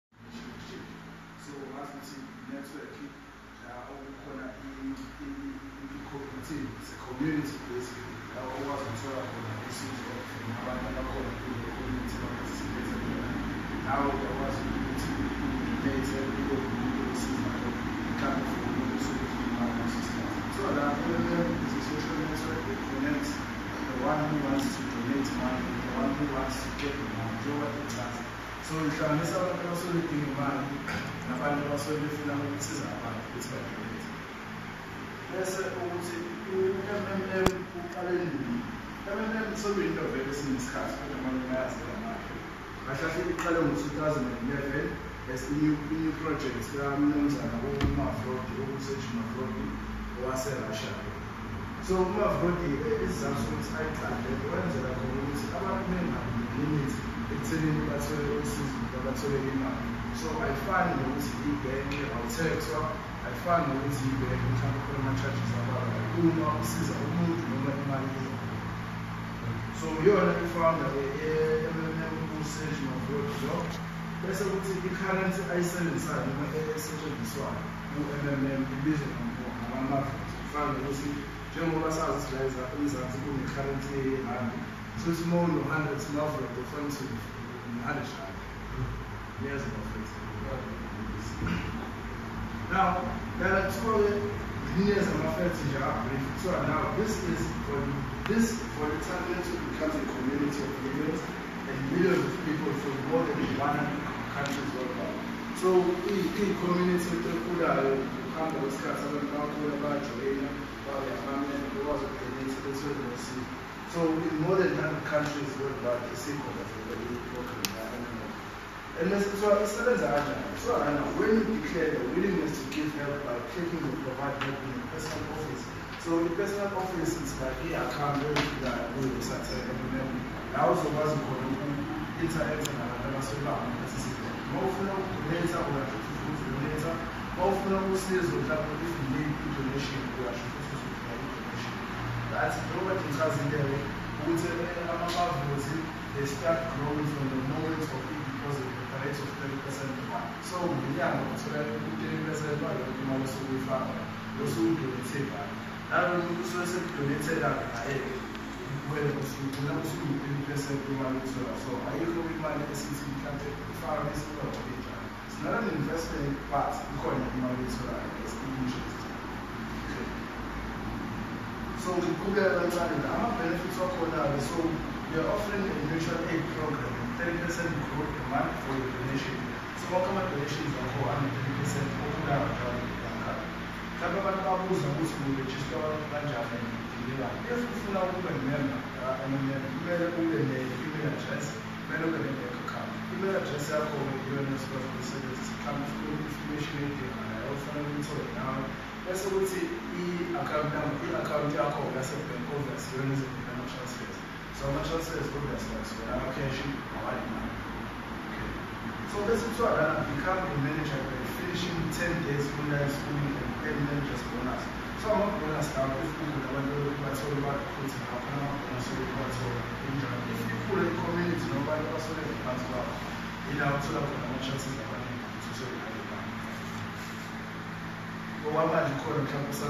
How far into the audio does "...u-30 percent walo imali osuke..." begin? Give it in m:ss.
2:31.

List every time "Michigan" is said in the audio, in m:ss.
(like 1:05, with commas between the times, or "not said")
not said.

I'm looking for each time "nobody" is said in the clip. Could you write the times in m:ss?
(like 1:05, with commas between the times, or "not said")
3:41.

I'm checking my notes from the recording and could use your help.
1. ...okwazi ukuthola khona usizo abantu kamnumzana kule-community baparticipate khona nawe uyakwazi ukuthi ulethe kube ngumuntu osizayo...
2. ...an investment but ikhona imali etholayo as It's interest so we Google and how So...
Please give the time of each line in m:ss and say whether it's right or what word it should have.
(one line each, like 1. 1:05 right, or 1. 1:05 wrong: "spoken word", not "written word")
1. 0:08 wrong: "abakhona", not "kamnumzana"
2. 2:45 right.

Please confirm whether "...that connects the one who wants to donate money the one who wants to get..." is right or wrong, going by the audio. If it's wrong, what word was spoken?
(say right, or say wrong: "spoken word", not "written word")
right.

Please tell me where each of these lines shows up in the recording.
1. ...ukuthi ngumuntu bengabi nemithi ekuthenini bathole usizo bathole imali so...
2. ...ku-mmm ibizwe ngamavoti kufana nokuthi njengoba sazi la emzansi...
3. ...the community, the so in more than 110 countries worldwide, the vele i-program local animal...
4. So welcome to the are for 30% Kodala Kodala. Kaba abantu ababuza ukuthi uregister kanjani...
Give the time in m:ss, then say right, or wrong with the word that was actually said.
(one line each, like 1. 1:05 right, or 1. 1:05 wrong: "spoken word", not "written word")
1. 0:55 wrong: "abantu", not "ngumuntu"
2. 1:17 right
3. 1:52 wrong: "100", not "110"
4. 2:59 right.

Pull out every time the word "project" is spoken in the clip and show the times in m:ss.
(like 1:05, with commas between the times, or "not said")
0:46.